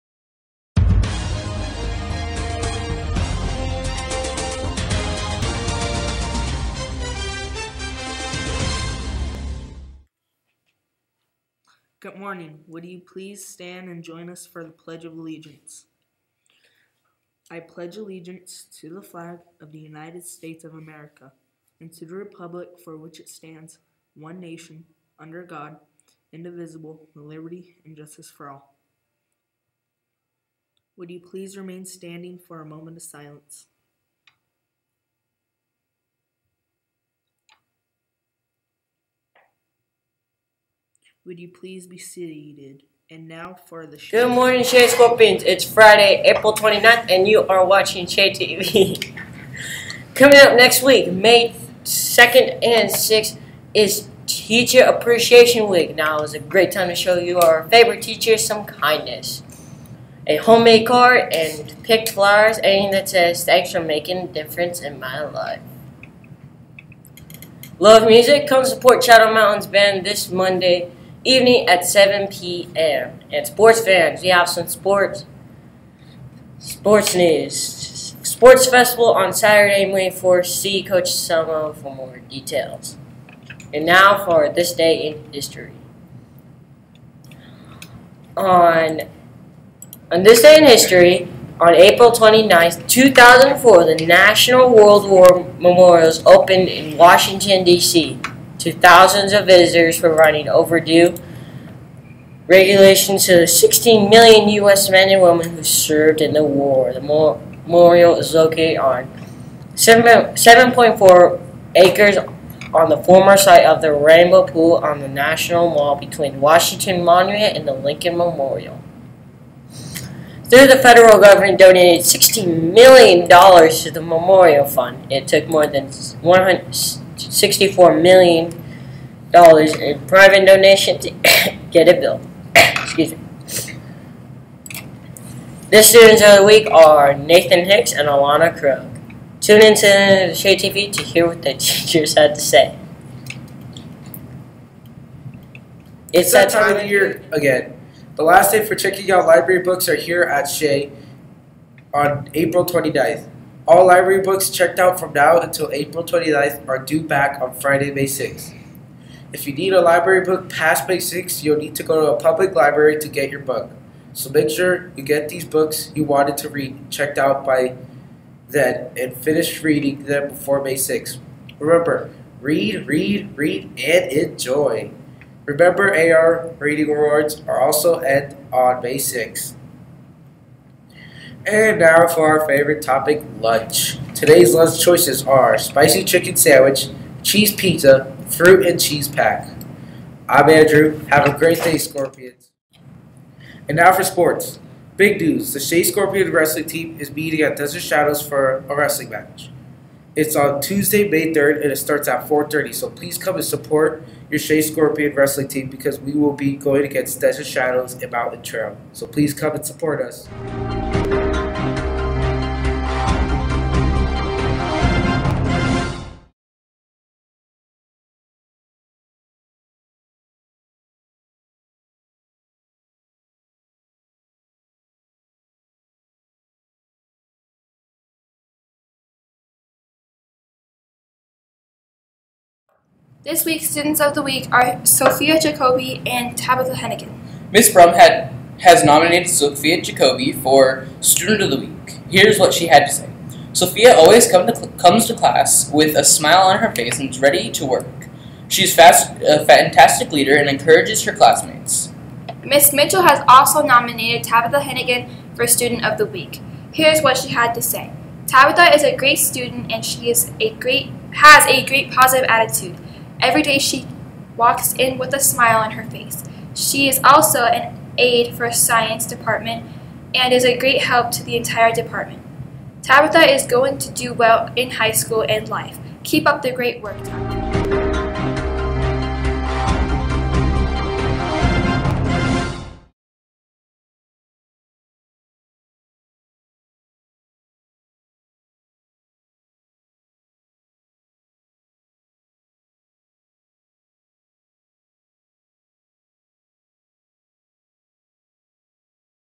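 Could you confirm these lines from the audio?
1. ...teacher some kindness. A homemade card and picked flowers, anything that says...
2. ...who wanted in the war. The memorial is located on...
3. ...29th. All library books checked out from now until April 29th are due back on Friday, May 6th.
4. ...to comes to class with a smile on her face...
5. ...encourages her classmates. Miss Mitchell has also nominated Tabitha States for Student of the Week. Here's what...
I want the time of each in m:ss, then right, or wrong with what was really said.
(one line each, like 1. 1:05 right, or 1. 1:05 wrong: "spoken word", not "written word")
1. 0:58 right
2. 1:45 wrong: "served", not "wanted"
3. 2:32 right
4. 4:04 right
5. 4:10 wrong: "Hennigan", not "States".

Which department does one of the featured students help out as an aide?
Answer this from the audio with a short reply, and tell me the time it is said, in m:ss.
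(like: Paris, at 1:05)
Science department, at 4:28.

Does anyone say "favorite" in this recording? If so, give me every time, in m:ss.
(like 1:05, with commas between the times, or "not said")
0:57, 3:02.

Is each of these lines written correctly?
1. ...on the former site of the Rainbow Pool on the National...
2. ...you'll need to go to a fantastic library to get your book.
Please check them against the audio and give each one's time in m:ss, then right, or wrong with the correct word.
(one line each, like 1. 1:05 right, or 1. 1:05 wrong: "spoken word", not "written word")
1. 1:52 right
2. 2:41 wrong: "public", not "fantastic".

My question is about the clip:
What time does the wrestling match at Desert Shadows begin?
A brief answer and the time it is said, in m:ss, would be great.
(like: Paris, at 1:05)
4:30, at 3:22.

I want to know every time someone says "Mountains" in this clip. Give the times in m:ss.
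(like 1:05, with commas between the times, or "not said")
1:09, 3:28.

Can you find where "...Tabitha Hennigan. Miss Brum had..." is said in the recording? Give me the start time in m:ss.
3:56.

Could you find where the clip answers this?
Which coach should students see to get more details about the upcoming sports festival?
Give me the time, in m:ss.
1:20.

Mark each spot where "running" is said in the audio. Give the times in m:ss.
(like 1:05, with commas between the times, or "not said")
1:40.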